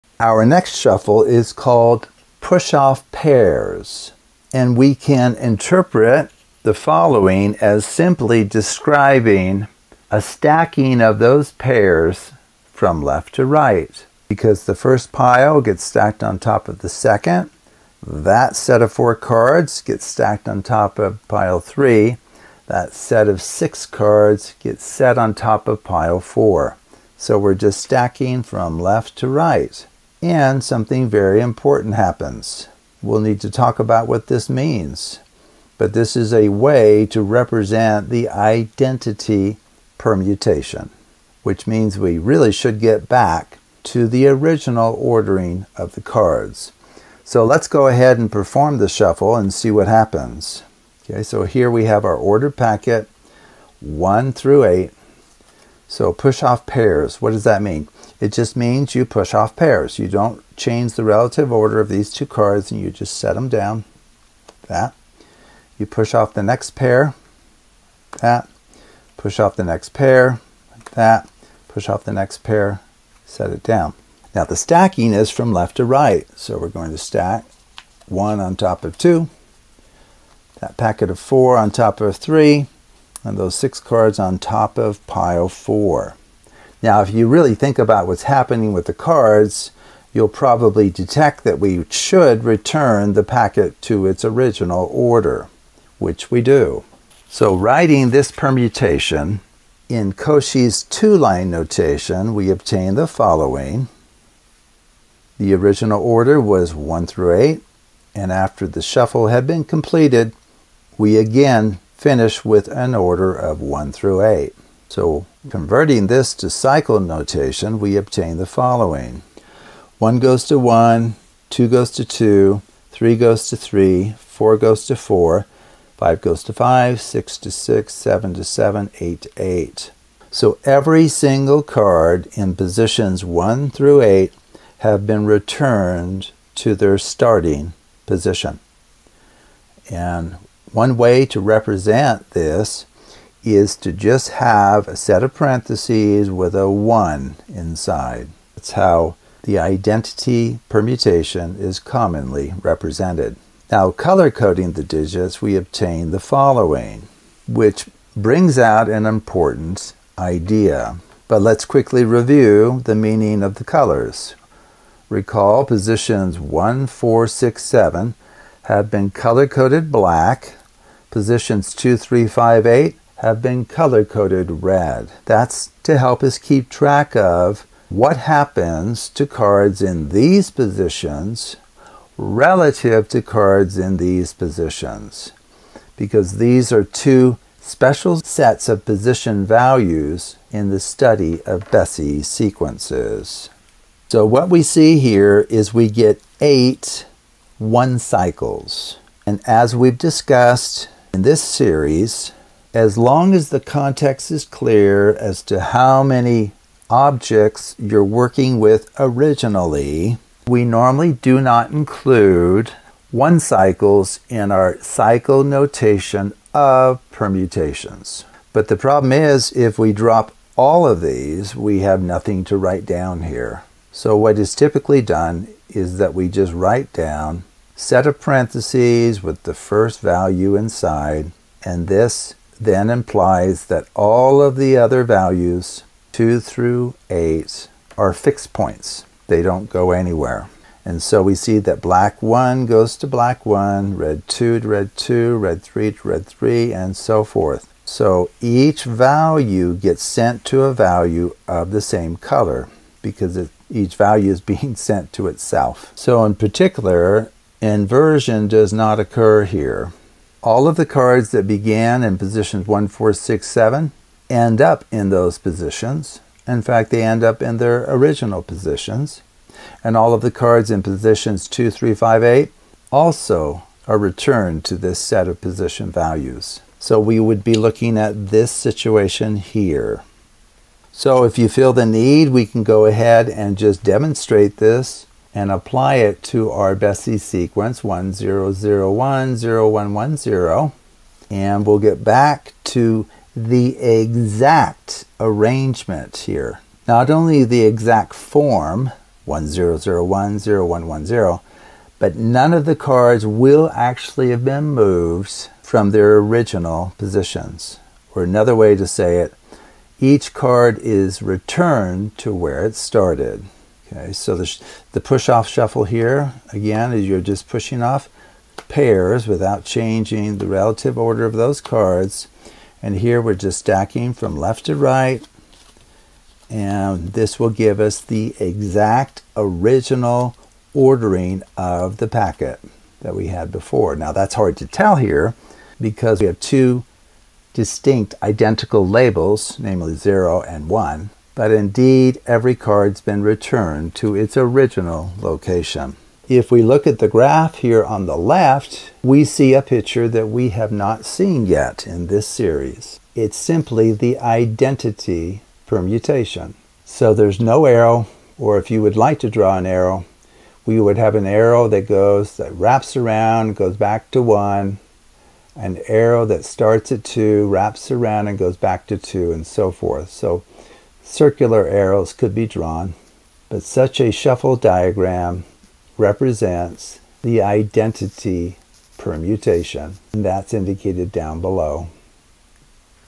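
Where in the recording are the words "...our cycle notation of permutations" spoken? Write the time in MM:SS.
03:34.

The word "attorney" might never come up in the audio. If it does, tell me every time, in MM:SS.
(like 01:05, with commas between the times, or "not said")
not said.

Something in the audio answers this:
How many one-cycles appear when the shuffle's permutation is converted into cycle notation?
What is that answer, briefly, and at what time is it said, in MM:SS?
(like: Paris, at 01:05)
8, at 03:16.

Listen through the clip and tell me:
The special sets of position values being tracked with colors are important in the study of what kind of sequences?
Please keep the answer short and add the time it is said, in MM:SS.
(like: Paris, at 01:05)
Bessey sequences, at 03:11.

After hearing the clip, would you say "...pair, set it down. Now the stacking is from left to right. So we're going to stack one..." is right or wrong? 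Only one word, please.
right.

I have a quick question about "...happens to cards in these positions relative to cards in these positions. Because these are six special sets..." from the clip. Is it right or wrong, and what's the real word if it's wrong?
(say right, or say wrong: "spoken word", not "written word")
wrong: "two", not "six".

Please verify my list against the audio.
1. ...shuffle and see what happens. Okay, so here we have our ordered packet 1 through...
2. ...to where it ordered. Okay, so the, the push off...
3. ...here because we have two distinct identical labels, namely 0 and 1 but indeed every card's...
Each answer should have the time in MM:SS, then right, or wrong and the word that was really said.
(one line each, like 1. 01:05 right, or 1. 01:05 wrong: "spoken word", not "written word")
1. 00:48 right
2. 05:12 wrong: "started", not "ordered"
3. 05:34 right.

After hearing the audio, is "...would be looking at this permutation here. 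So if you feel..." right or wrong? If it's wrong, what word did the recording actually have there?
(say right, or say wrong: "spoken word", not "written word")
wrong: "situation", not "permutation".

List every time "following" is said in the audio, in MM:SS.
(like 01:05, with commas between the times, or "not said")
00:06, 01:43, 01:58, 02:36.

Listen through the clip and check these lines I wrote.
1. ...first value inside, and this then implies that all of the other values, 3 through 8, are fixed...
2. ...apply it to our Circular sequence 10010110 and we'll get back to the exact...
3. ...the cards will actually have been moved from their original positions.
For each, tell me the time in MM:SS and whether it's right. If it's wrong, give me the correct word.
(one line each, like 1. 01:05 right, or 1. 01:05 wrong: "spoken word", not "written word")
1. 03:49 wrong: "2", not "3"
2. 04:45 wrong: "Bessey", not "Circular"
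3. 05:02 right.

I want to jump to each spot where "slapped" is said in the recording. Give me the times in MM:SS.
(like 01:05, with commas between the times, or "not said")
not said.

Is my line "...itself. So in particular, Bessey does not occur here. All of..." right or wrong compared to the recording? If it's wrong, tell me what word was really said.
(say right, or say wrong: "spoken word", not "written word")
wrong: "Inversion", not "Bessey".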